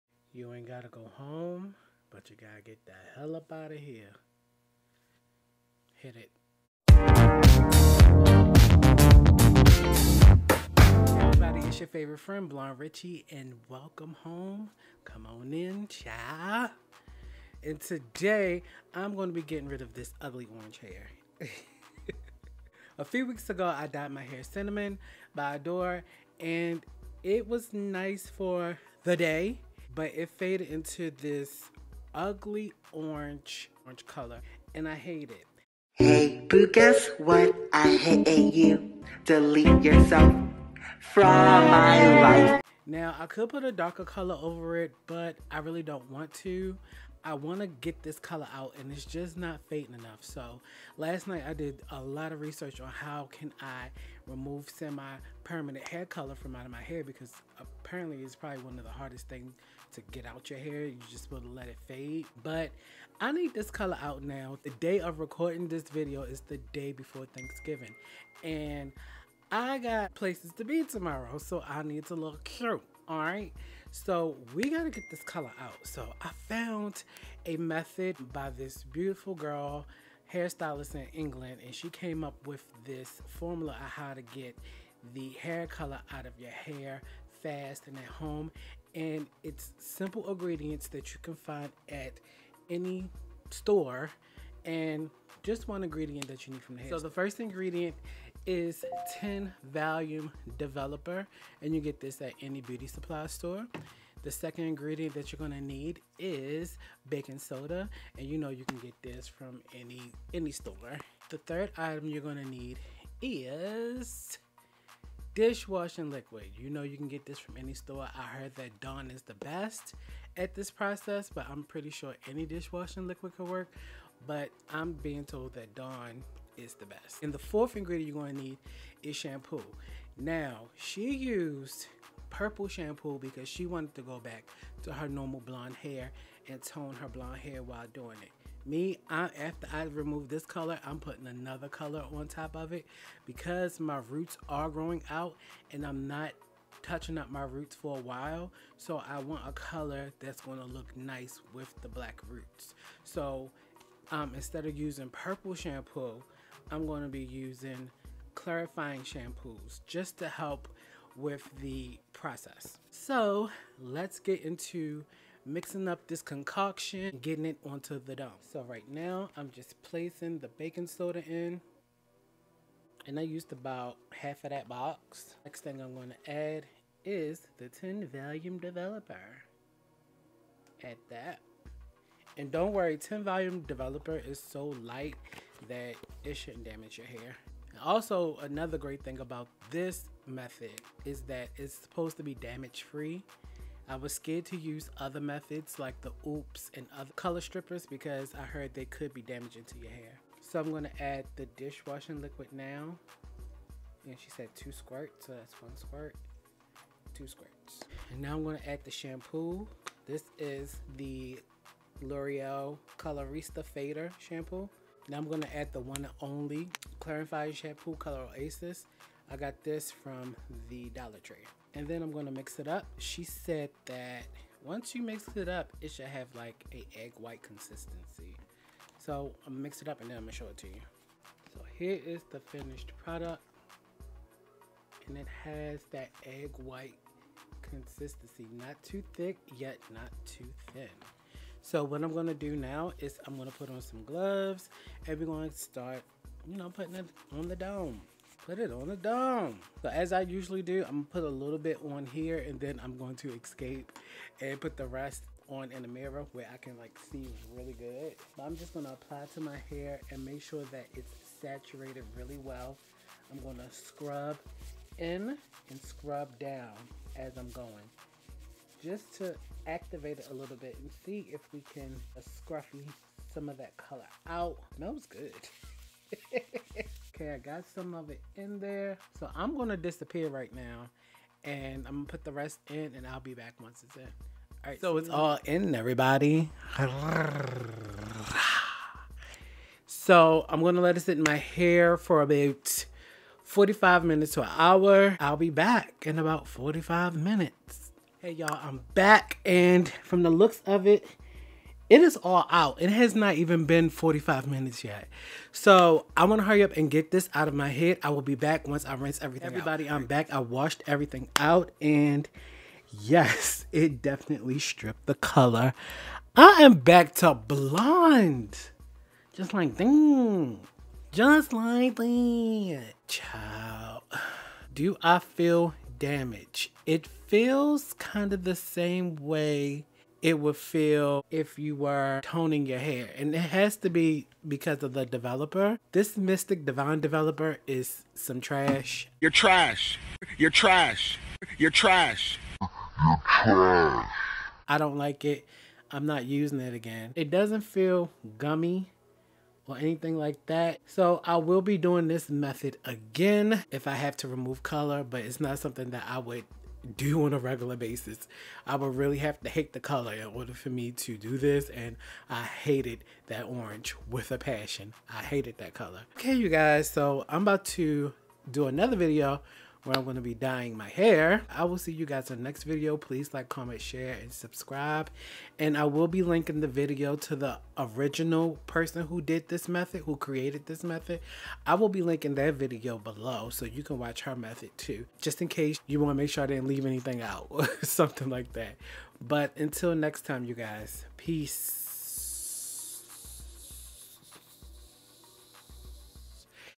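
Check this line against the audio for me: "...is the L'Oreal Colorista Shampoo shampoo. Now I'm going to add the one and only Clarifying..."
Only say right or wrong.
wrong.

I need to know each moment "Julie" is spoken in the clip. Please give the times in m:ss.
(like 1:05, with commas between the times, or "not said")
not said.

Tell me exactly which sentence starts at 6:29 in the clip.
But until next time, you guys, peace.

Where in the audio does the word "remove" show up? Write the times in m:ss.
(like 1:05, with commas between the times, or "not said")
0:54, 2:19, 5:54.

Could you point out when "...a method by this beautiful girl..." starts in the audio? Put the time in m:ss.
1:17.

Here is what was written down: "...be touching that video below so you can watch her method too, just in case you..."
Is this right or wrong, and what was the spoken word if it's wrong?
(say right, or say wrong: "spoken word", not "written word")
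wrong: "linking", not "touching".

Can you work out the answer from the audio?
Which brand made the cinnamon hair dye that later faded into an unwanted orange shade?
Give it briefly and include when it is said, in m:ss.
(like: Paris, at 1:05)
Adore, at 0:25.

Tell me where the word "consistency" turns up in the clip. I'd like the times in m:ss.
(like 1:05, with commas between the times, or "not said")
3:47, 3:57.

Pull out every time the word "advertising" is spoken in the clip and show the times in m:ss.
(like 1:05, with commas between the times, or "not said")
not said.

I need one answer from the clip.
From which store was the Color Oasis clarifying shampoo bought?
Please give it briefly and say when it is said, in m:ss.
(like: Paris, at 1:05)
Dollar Tree, at 3:40.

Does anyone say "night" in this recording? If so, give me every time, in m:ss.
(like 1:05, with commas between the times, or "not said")
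0:51.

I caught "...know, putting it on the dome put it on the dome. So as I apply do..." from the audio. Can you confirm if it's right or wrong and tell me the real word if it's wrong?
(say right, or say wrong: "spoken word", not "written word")
wrong: "usually", not "apply".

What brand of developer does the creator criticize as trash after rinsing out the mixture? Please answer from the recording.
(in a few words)
Mystic Divine.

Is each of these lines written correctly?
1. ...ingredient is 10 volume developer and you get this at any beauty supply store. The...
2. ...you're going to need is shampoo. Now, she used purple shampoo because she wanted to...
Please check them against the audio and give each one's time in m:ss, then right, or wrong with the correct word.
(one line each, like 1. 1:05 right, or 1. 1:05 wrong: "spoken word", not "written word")
1. 1:37 right
2. 2:08 right.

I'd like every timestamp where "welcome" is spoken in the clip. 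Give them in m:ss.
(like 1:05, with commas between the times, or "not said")
0:13.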